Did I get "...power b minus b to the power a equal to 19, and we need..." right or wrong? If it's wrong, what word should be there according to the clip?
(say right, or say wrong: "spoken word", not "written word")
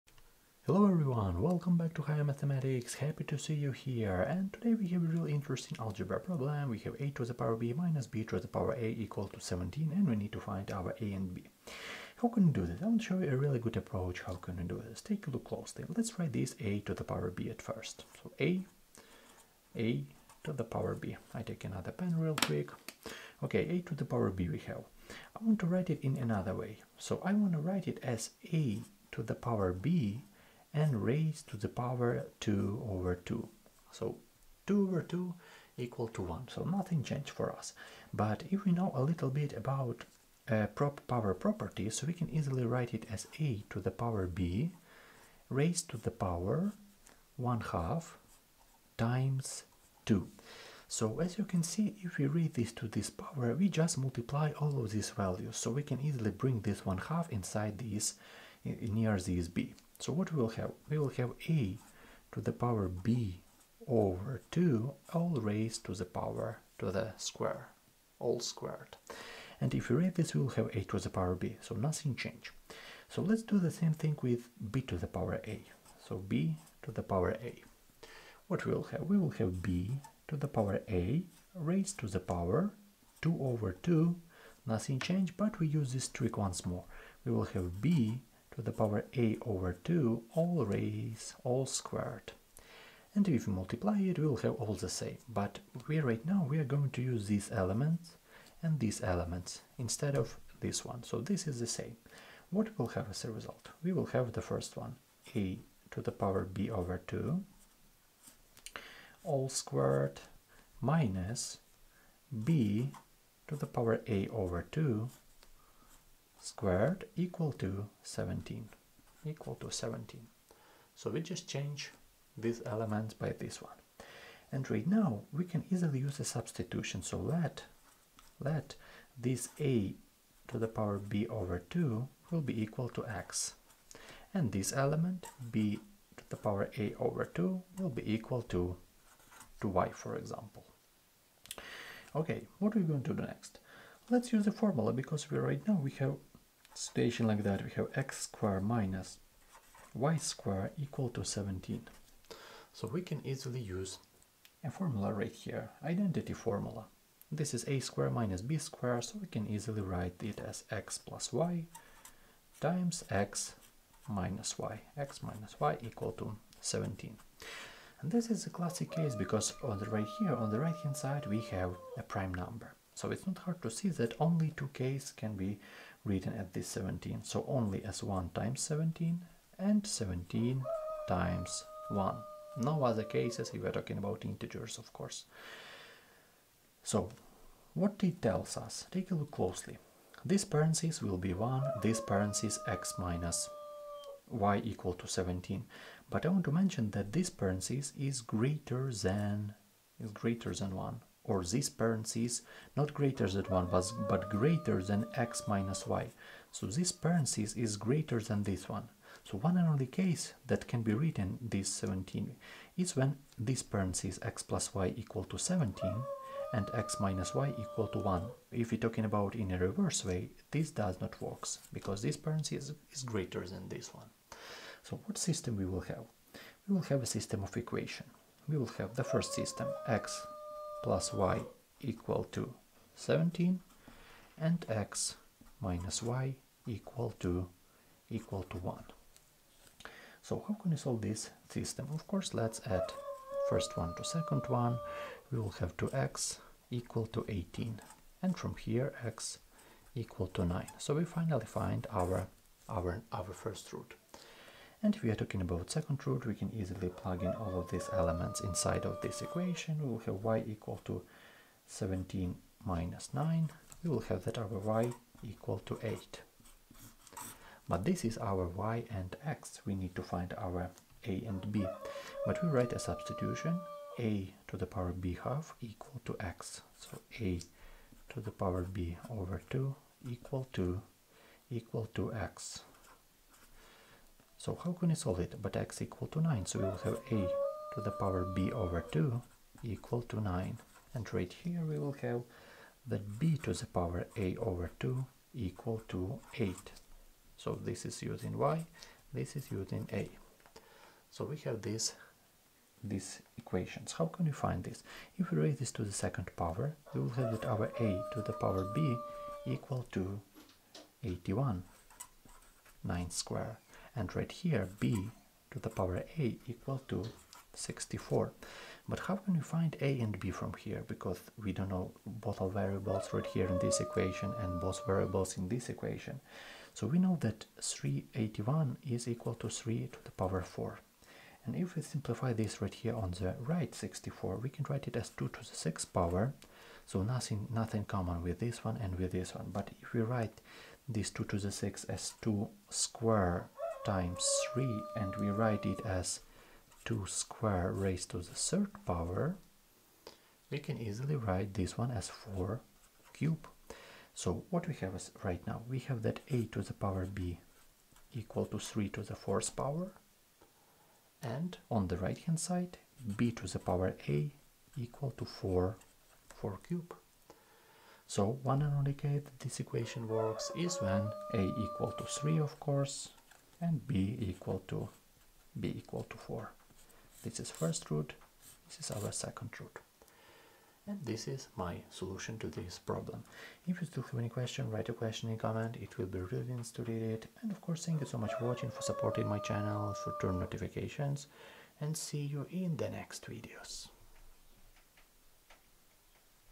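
wrong: "17", not "19".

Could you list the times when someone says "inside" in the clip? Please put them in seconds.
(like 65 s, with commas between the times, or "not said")
57 s, 258 s.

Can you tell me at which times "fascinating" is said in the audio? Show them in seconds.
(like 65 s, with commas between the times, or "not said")
not said.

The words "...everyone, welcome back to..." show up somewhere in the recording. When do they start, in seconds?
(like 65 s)
0 s.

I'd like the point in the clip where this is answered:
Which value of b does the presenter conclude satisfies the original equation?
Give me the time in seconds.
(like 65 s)
375 s.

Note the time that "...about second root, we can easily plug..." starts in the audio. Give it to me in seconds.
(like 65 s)
255 s.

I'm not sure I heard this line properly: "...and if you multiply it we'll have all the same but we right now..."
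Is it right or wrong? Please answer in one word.
right.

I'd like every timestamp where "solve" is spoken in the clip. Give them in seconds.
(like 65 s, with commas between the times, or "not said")
240 s, 284 s.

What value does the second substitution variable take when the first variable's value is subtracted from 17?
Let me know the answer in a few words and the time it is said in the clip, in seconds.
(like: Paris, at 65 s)
8, at 264 s.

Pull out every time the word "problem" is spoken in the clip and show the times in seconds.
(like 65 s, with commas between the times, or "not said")
6 s, 382 s.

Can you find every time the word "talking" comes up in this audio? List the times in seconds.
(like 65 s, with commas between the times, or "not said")
183 s, 218 s, 255 s.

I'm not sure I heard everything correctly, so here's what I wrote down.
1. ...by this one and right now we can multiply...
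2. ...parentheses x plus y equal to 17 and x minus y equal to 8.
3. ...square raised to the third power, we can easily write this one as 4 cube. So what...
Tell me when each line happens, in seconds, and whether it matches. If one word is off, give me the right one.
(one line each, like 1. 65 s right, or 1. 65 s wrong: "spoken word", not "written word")
1. 123 s wrong: "easily", not "multiply"
2. 213 s wrong: "1", not "8"
3. 347 s right.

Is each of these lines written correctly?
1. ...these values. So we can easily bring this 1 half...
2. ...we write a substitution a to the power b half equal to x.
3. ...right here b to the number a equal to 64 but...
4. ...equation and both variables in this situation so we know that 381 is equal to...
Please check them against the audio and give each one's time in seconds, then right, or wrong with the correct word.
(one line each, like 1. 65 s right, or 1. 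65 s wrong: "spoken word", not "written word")
1. 54 s right
2. 272 s right
3. 314 s wrong: "power", not "number"
4. 323 s wrong: "equation", not "situation".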